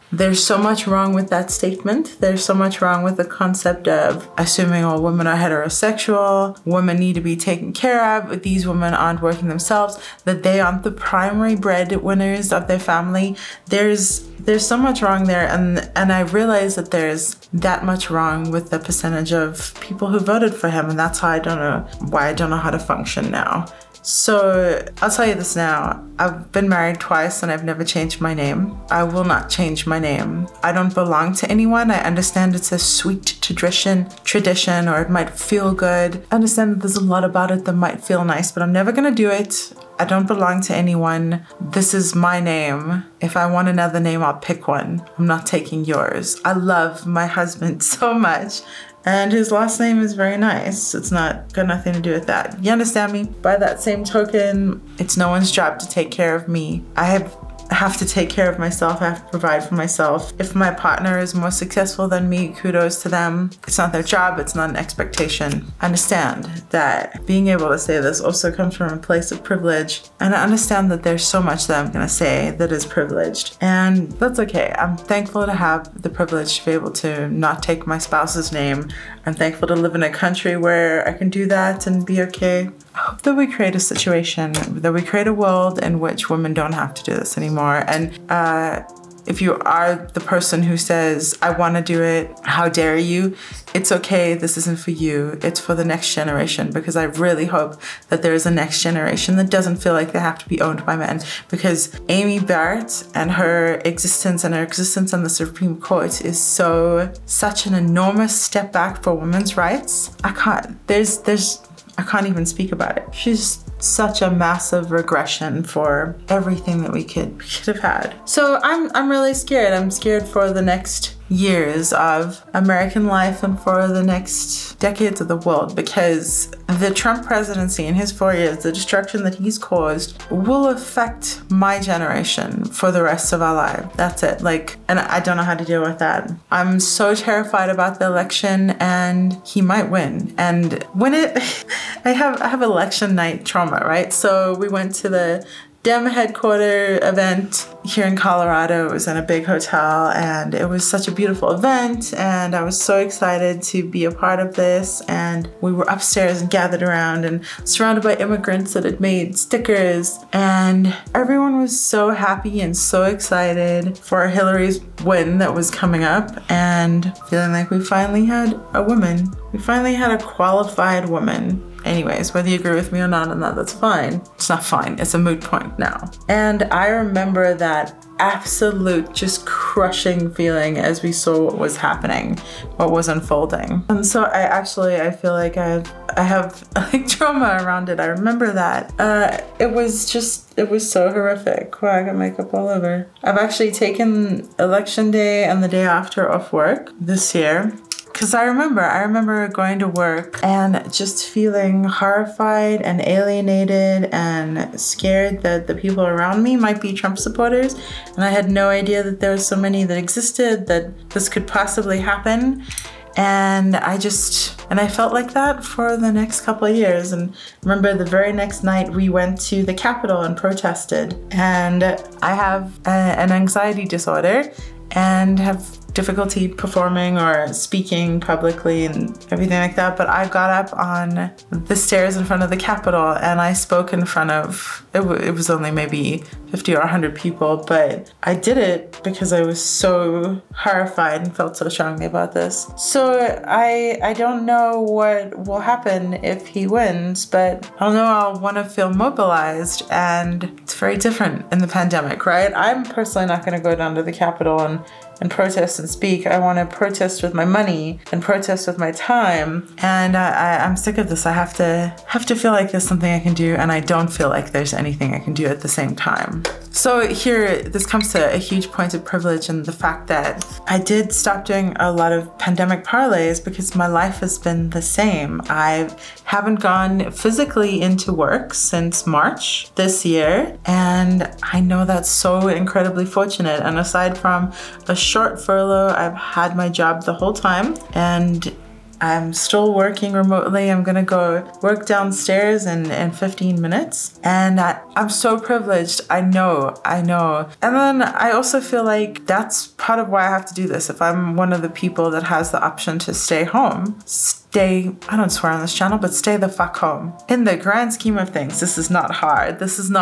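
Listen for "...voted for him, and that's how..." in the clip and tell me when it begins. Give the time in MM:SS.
00:20.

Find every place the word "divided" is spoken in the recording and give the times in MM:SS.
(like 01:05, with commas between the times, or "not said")
not said.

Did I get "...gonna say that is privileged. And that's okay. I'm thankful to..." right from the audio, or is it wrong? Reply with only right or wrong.
right.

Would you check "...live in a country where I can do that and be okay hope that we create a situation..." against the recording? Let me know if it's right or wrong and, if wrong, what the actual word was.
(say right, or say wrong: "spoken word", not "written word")
right.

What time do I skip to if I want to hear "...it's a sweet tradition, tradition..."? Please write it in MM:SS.
00:32.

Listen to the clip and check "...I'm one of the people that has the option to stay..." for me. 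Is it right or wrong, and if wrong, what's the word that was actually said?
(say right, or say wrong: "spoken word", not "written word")
right.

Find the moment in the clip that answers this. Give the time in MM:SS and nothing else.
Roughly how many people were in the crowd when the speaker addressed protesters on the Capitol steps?
03:56.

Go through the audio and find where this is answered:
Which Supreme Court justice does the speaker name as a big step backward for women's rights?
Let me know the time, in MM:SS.
01:42.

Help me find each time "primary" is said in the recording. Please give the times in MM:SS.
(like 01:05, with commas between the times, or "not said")
00:10.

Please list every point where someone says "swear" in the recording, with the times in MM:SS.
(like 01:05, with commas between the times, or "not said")
05:05.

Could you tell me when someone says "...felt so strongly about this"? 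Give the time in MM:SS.
04:01.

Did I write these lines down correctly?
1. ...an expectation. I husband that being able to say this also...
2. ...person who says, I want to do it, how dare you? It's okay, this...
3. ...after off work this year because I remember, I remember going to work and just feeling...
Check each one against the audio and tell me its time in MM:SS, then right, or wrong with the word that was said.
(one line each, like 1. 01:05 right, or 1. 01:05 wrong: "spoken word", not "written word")
1. 01:04 wrong: "understand", not "husband"
2. 01:30 right
3. 03:15 right.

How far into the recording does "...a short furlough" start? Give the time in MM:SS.
04:44.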